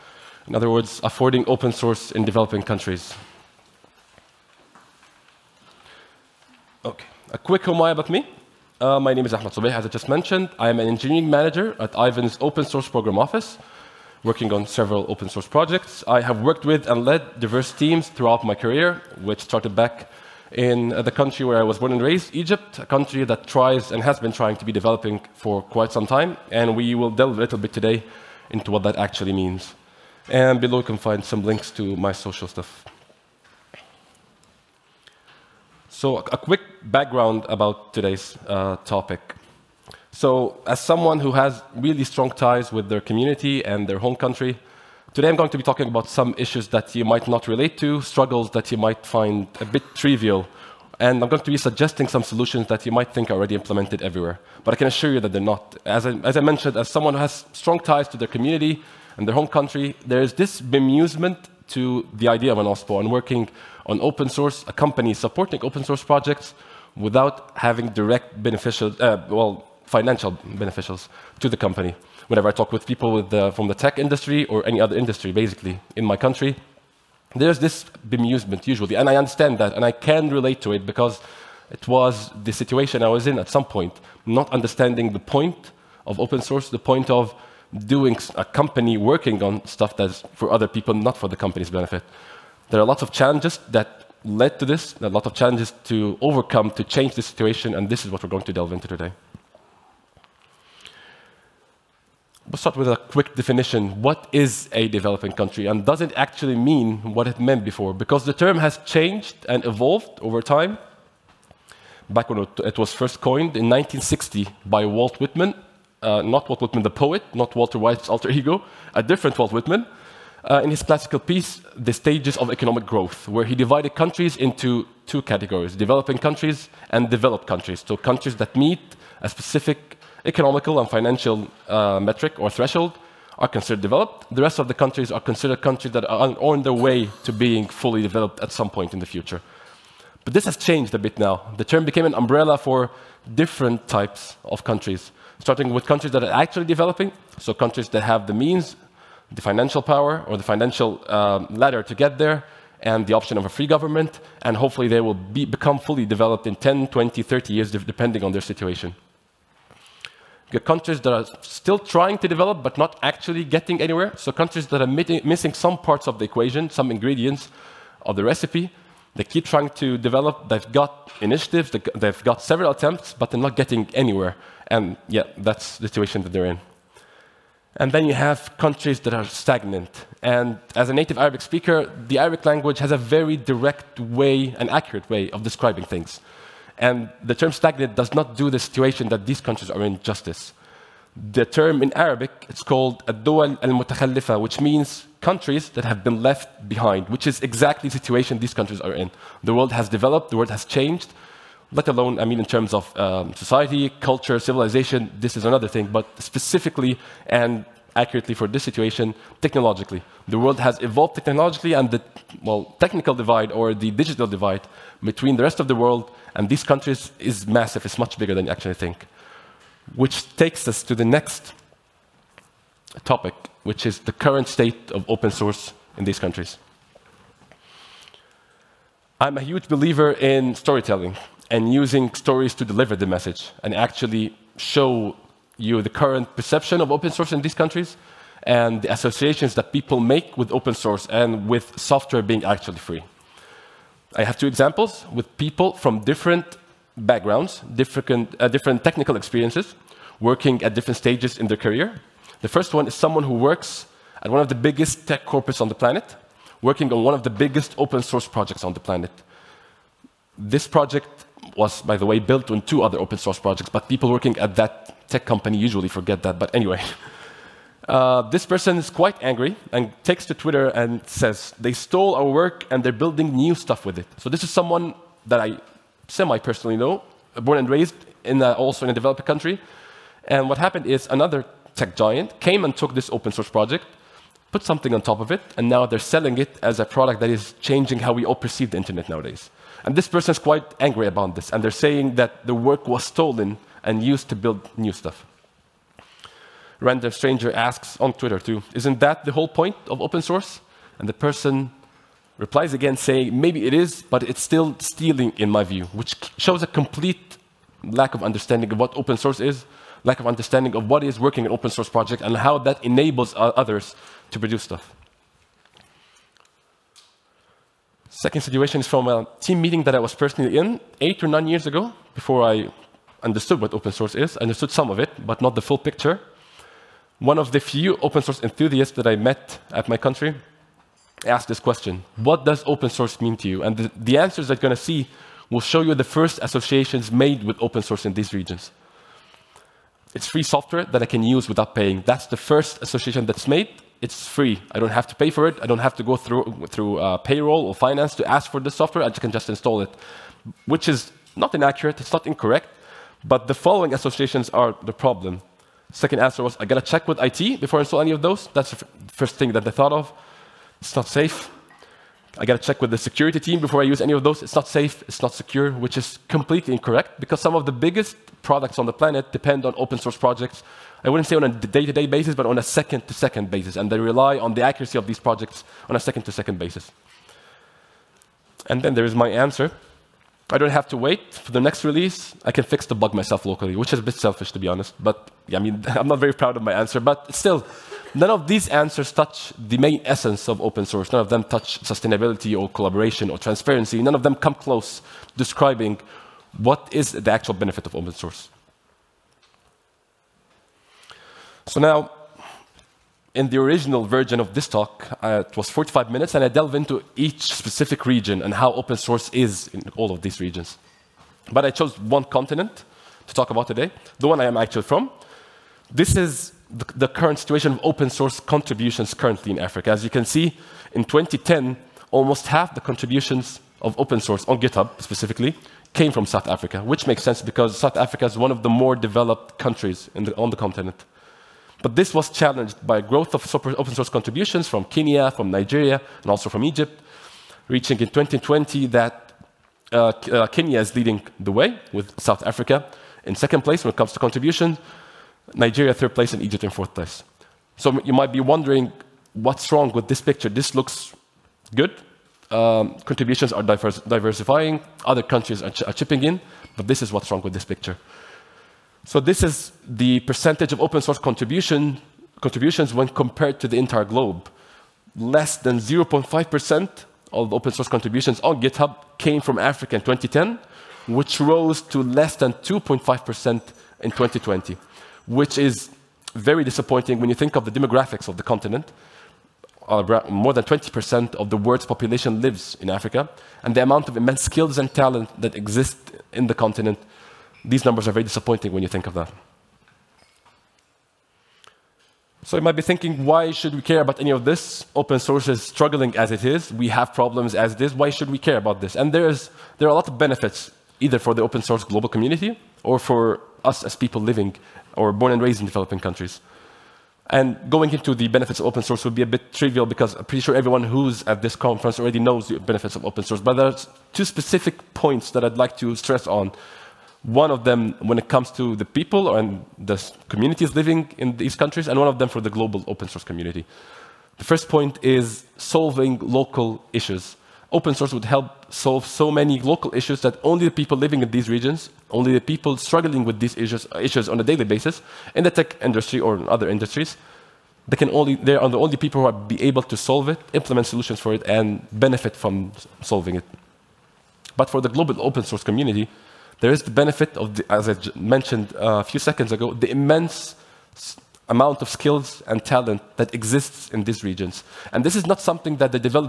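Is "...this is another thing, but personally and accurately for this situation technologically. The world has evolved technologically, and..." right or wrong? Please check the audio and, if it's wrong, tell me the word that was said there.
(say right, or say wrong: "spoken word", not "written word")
wrong: "specifically", not "personally".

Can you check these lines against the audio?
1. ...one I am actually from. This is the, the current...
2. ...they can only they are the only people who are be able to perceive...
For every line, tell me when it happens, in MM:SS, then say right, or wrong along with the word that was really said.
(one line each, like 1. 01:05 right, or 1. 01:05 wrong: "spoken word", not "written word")
1. 06:54 right
2. 08:57 wrong: "solve", not "perceive".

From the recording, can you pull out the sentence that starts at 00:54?
But I can assure you that they're not.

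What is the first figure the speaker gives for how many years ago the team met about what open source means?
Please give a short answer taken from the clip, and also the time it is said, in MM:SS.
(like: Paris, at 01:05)
8, at 05:20.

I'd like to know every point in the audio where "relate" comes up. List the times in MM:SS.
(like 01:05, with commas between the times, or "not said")
00:47, 01:20.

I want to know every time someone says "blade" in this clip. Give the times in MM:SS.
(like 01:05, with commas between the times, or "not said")
not said.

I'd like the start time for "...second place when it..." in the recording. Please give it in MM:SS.
07:23.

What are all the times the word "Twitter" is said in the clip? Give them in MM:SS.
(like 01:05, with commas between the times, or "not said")
04:30, 04:58.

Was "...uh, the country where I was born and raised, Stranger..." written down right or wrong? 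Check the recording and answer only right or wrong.
wrong.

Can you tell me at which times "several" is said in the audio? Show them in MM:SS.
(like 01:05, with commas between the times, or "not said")
00:14, 02:52.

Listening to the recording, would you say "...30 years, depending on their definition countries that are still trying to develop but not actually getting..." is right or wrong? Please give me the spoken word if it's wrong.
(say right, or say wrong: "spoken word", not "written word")
wrong: "situation", not "definition".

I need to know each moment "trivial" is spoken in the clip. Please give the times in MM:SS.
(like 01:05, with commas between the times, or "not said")
00:49, 08:29.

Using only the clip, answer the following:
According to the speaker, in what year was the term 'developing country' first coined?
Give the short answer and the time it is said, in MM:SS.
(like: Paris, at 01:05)
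1960, at 01:53.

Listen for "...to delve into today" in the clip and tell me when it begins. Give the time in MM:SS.
01:38.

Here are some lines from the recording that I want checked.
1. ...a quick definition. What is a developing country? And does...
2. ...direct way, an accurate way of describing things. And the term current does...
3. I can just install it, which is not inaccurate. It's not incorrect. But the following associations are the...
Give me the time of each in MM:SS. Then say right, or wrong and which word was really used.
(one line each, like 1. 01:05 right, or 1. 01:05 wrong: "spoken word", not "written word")
1. 01:42 right
2. 03:03 wrong: "stagnant", not "current"
3. 05:49 right.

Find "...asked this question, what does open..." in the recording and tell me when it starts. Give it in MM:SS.
05:31.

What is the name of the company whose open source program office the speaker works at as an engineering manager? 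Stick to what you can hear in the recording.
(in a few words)
Aiven.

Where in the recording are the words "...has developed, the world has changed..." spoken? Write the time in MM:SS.
03:19.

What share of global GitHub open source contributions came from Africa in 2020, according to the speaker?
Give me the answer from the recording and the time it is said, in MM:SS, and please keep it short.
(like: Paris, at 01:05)
less than 2.5%, at 07:52.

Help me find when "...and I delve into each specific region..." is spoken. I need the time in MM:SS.
06:46.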